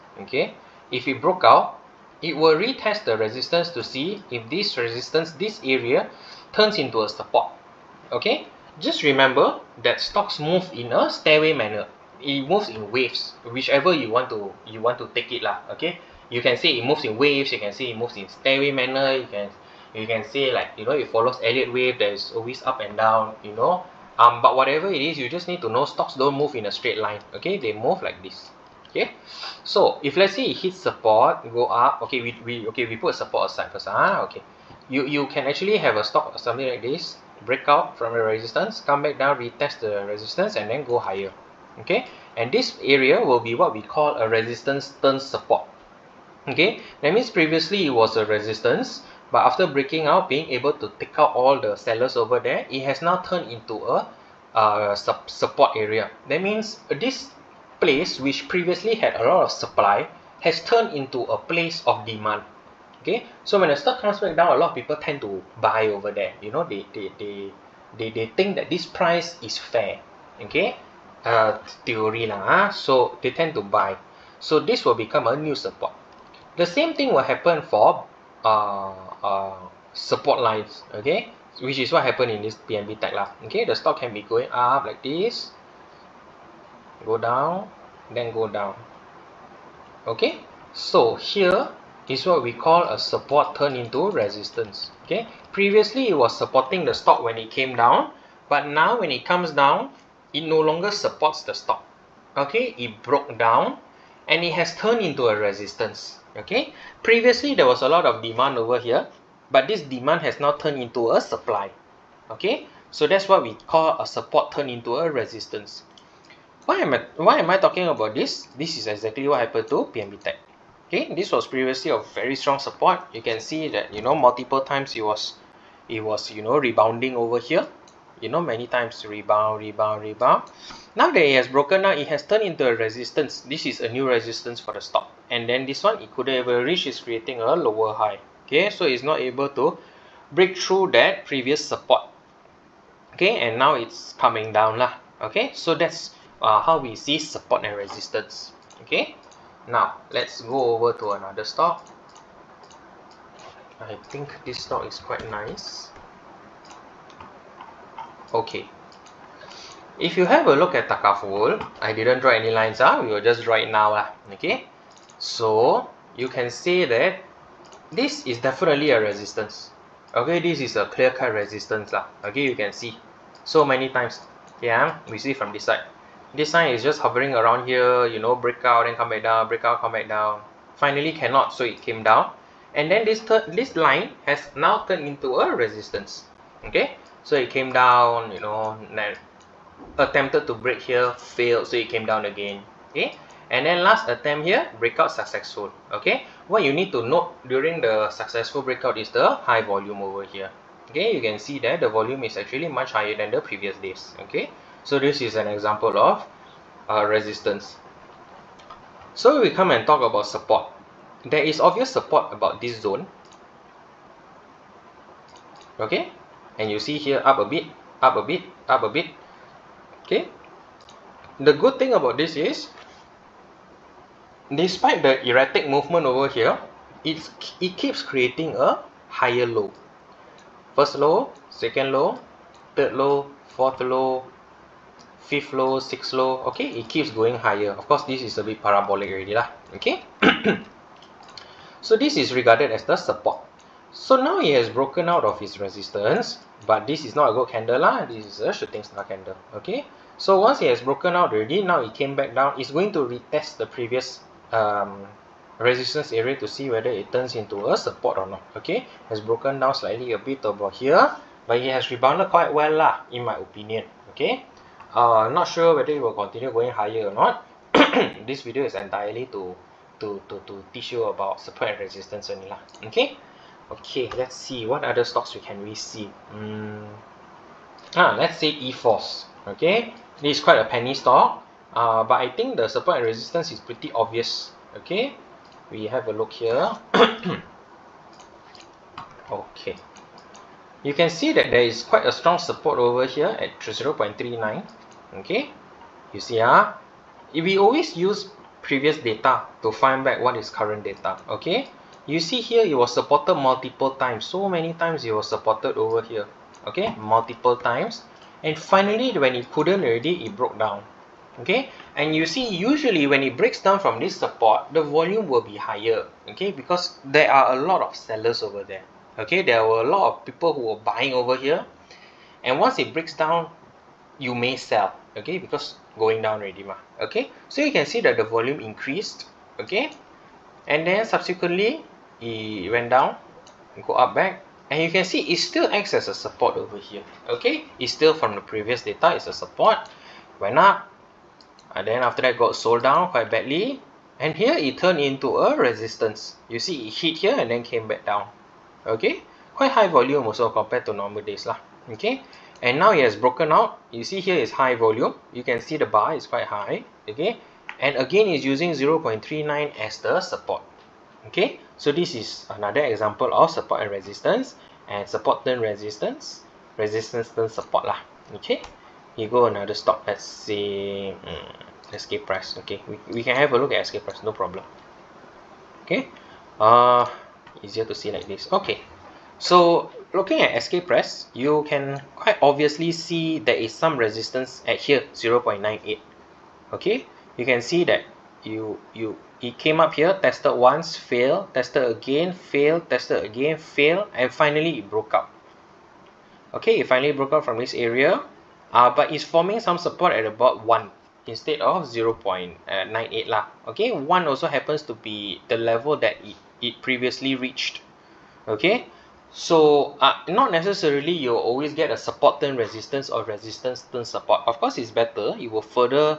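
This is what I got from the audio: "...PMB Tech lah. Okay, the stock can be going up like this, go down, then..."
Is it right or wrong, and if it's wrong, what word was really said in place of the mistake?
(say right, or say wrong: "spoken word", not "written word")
right.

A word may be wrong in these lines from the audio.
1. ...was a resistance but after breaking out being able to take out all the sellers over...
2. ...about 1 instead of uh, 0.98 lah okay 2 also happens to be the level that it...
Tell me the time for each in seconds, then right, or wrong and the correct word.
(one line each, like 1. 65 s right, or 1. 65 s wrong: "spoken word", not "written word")
1. 47 s right
2. 400 s wrong: "1", not "2".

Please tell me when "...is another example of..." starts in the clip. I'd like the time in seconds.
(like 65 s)
362 s.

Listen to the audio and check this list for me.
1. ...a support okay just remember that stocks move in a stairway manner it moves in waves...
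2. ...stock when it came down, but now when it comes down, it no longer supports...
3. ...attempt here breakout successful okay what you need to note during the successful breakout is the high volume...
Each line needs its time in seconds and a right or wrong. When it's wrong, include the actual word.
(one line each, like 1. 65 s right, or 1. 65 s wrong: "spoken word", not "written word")
1. 7 s right
2. 96 s right
3. 194 s right.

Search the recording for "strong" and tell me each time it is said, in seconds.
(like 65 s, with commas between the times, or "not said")
122 s, 292 s.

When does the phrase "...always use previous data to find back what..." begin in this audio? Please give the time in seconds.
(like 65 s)
297 s.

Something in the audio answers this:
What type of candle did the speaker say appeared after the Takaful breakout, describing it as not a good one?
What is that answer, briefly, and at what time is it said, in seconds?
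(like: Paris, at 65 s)
Shooting star, at 248 s.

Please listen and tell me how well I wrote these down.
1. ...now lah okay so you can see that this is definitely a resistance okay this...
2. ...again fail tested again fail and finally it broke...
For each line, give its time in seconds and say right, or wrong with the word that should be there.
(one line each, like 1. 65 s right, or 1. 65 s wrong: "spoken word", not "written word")
1. 163 s right
2. 391 s right.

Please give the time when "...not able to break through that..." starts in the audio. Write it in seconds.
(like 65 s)
139 s.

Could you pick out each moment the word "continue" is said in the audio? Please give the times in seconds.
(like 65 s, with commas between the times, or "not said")
266 s.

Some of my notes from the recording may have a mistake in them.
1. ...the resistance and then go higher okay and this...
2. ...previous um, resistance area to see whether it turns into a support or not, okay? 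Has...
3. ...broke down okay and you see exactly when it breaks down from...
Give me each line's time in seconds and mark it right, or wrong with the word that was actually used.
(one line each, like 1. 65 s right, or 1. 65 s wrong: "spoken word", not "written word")
1. 39 s right
2. 253 s right
3. 310 s wrong: "usually", not "exactly".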